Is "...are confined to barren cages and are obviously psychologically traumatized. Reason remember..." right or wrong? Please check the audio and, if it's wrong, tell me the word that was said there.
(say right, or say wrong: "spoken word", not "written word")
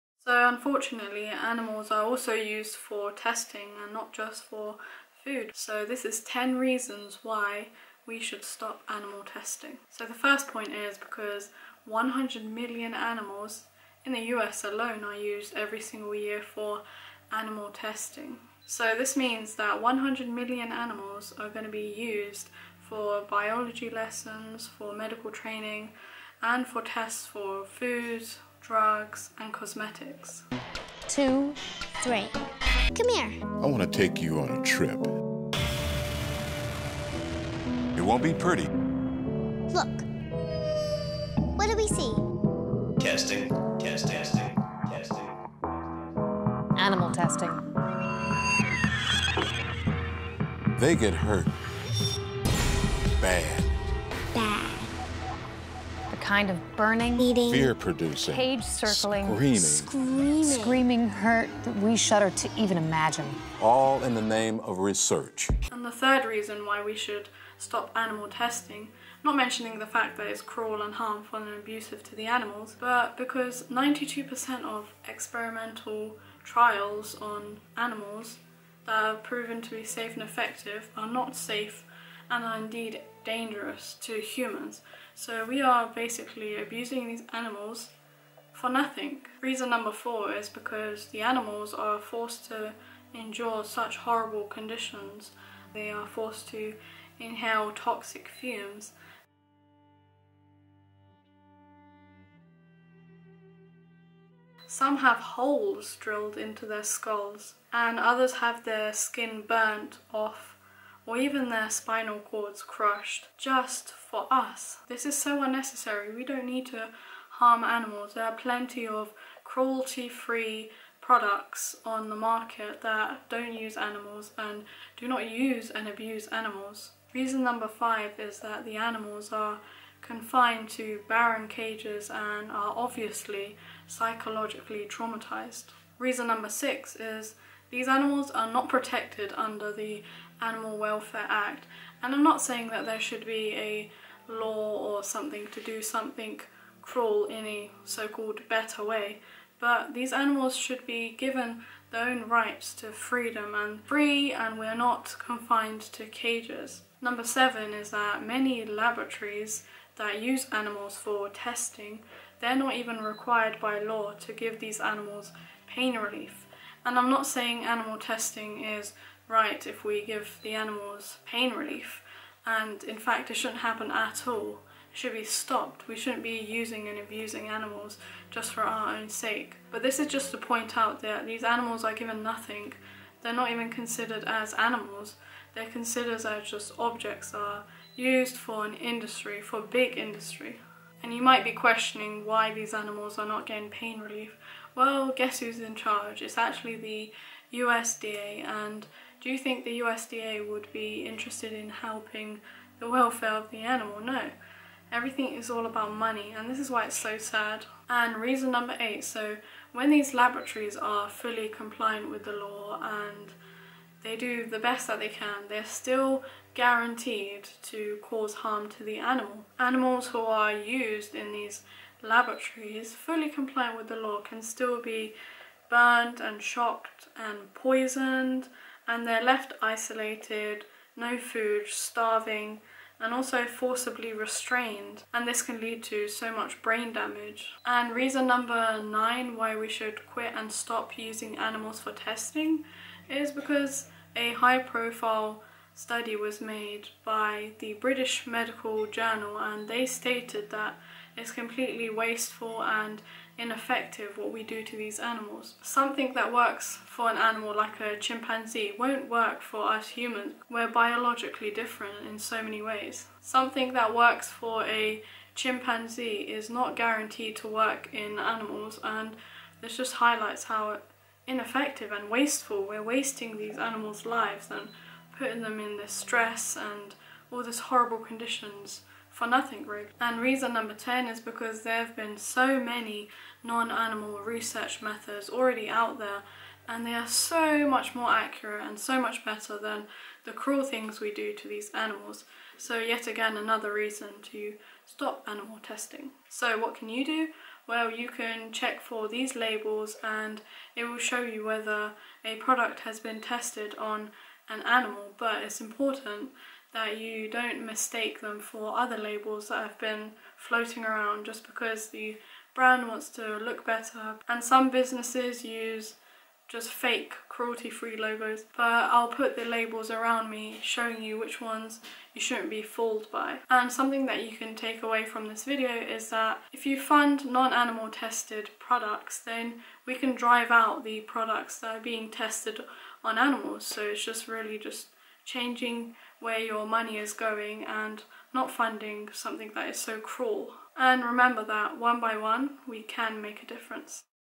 wrong: "number", not "remember".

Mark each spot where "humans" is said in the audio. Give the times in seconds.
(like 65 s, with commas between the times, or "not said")
84 s, 259 s.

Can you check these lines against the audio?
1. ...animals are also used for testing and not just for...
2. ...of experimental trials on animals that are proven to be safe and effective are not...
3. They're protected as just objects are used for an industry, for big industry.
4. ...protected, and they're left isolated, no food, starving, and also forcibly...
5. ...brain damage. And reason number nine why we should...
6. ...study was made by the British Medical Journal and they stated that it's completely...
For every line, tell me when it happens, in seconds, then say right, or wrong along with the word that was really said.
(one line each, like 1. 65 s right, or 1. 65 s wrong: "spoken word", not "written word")
1. 1 s right
2. 74 s right
3. 185 s wrong: "considered", not "protected"
4. 227 s wrong: "poisoned", not "protected"
5. 236 s right
6. 245 s right.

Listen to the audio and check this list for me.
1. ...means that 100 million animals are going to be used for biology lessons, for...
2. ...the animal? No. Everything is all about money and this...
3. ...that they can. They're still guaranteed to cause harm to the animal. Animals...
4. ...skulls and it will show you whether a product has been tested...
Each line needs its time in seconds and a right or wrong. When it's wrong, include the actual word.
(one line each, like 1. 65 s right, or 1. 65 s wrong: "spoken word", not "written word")
1. 19 s right
2. 203 s right
3. 214 s right
4. 299 s wrong: "labels", not "skulls".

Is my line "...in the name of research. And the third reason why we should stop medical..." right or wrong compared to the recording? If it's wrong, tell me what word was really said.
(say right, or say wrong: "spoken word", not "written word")
wrong: "animal", not "medical".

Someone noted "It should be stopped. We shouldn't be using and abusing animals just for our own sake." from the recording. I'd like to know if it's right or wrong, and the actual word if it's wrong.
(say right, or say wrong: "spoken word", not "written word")
right.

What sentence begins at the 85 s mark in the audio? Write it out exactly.
So we are basically abusing these animals for nothing.